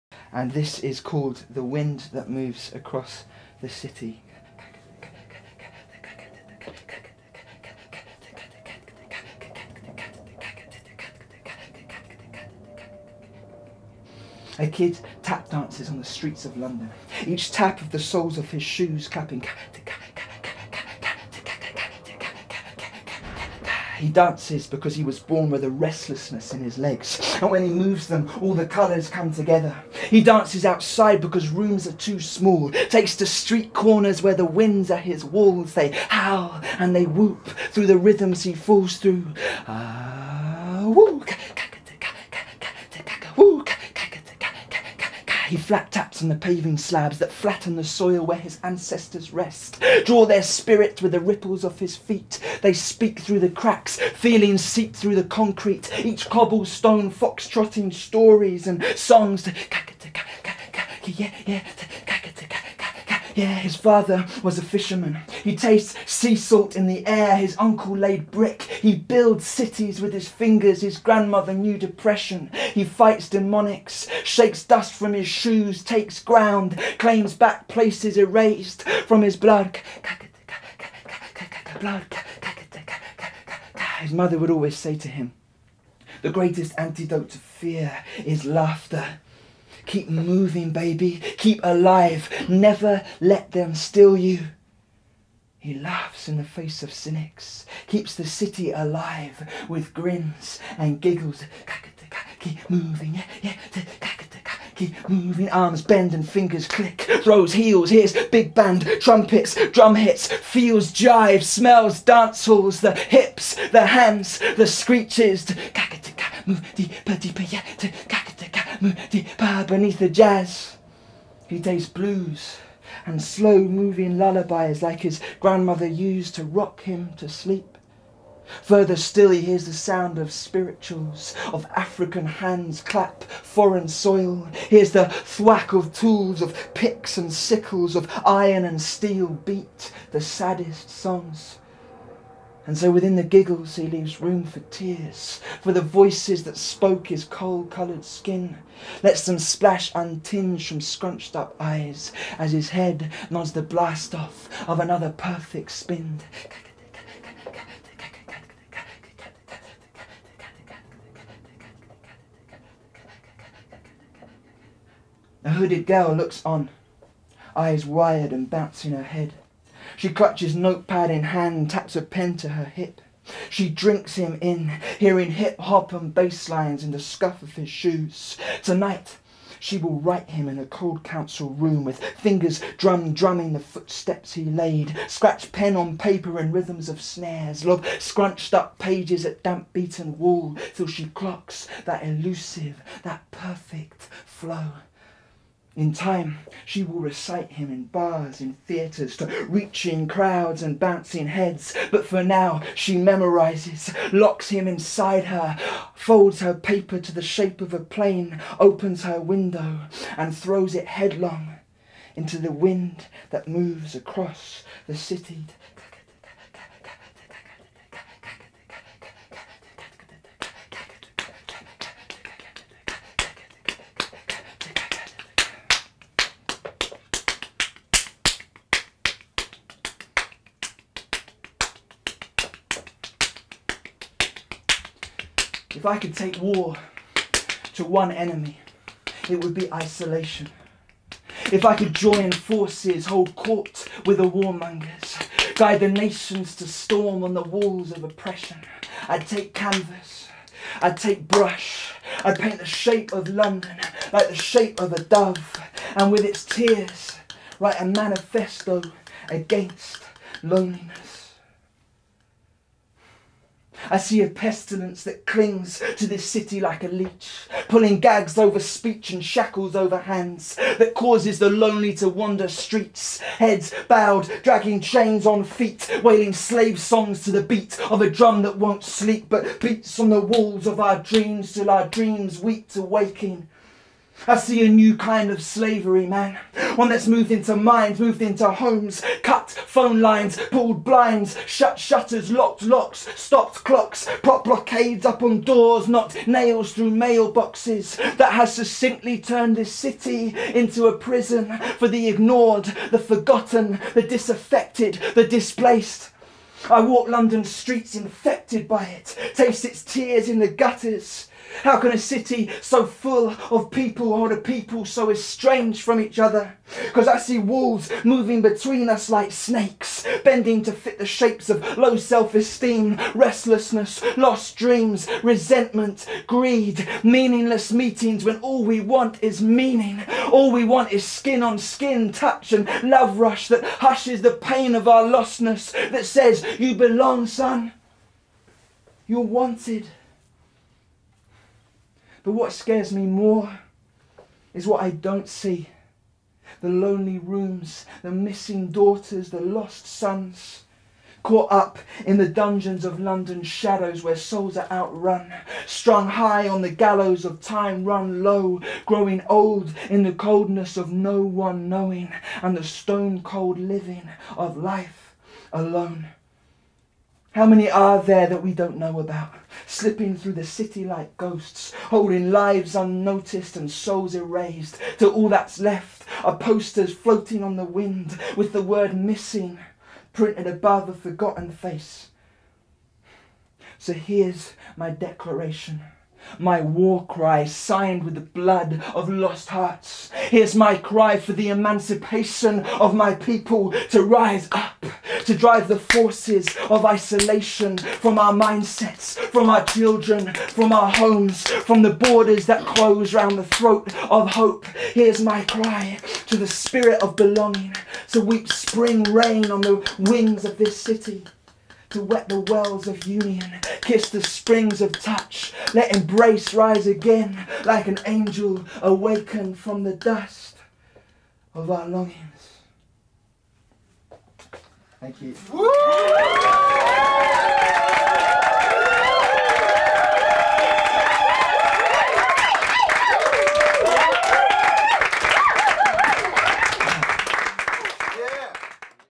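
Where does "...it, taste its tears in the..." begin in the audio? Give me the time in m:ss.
5:08.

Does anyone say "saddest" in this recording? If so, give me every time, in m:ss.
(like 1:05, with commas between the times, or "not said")
2:20.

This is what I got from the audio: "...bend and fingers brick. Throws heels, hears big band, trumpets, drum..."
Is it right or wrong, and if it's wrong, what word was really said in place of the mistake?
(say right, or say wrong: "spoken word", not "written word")
wrong: "click", not "brick".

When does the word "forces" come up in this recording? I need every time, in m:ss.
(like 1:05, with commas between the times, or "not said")
4:02, 6:35.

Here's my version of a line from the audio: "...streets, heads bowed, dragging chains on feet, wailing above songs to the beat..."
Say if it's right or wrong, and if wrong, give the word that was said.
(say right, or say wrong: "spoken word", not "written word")
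wrong: "slave", not "above".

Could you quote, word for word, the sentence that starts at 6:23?
So here's my declaration my war cry signed with the blood of lost hearts.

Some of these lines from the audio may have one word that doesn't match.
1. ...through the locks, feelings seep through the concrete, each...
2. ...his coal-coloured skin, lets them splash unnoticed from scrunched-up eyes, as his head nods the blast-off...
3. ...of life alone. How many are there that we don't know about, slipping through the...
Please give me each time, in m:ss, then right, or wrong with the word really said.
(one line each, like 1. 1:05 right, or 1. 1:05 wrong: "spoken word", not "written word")
1. 0:53 wrong: "cracks", not "locks"
2. 2:27 wrong: "untinged", not "unnoticed"
3. 6:04 right.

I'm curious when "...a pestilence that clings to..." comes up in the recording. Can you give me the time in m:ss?
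4:24.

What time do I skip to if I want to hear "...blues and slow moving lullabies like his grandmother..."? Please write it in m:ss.
2:01.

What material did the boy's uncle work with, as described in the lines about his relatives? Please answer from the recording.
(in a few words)
Brick.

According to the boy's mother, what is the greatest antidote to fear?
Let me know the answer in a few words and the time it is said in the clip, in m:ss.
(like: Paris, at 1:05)
Laughter, at 1:28.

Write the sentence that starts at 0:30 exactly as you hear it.
He dances outside because rooms are too small, takes to street corners where the winds are his walls.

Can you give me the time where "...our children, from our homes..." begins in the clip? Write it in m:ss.
6:39.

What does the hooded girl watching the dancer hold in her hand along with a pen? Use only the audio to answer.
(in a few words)
Notepad.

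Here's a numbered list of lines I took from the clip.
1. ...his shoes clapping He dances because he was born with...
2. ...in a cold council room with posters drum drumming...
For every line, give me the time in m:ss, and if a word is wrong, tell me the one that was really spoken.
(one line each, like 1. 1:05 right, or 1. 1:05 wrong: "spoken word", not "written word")
1. 0:18 right
2. 3:00 wrong: "fingers", not "posters".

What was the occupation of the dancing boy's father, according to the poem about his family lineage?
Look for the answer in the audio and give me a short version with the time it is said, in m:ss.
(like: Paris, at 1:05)
Fisherman, at 1:04.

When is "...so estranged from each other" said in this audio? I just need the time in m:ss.
5:14.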